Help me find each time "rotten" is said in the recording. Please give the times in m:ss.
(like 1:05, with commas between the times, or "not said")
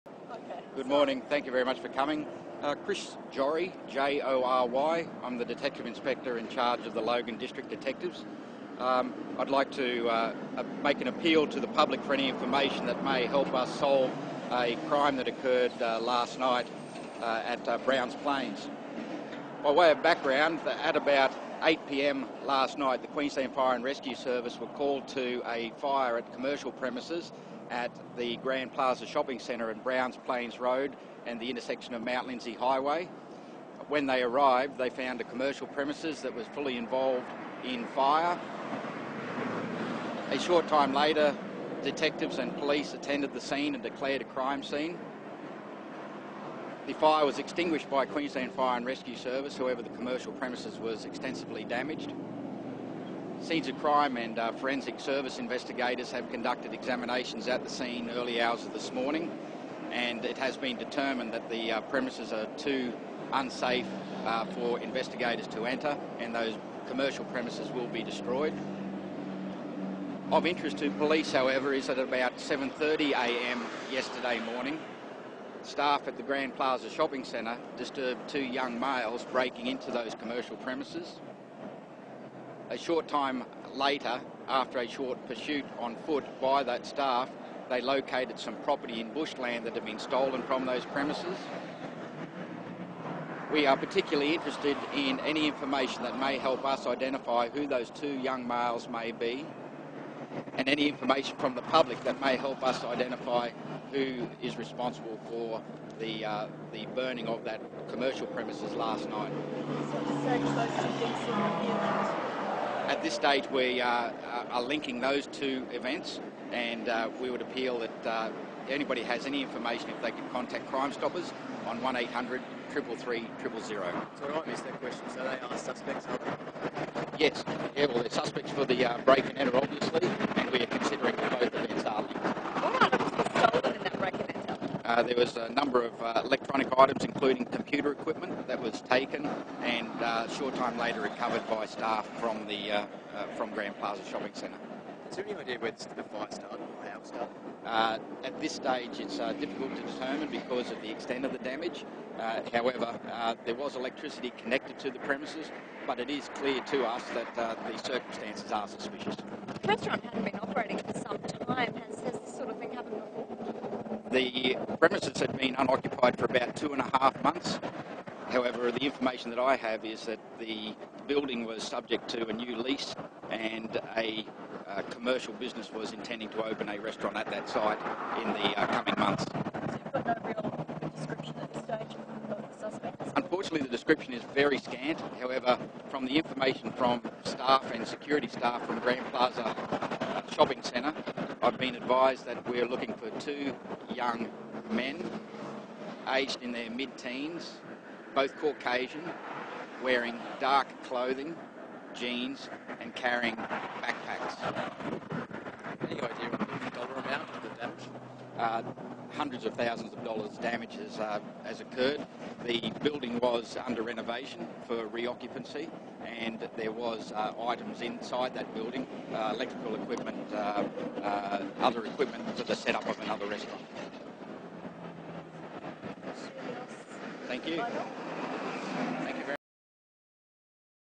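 not said.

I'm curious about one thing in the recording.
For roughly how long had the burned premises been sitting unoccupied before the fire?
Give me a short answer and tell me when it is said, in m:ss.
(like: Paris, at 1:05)
About two and a half months, at 2:46.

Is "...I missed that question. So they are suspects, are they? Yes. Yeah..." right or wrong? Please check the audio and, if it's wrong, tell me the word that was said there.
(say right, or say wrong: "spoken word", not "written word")
right.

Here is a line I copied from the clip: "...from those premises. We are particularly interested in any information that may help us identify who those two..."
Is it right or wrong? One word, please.
right.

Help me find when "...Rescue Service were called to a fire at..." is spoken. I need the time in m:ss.
0:23.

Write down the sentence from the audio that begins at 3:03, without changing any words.
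Unfortunately, the description is very scant.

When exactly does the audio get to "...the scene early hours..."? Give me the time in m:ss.
0:57.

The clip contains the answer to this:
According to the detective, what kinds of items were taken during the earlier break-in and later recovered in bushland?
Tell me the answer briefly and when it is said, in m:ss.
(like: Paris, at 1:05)
Computer equipment, at 2:17.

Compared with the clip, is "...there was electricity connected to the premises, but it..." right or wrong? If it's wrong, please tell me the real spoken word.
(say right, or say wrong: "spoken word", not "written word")
right.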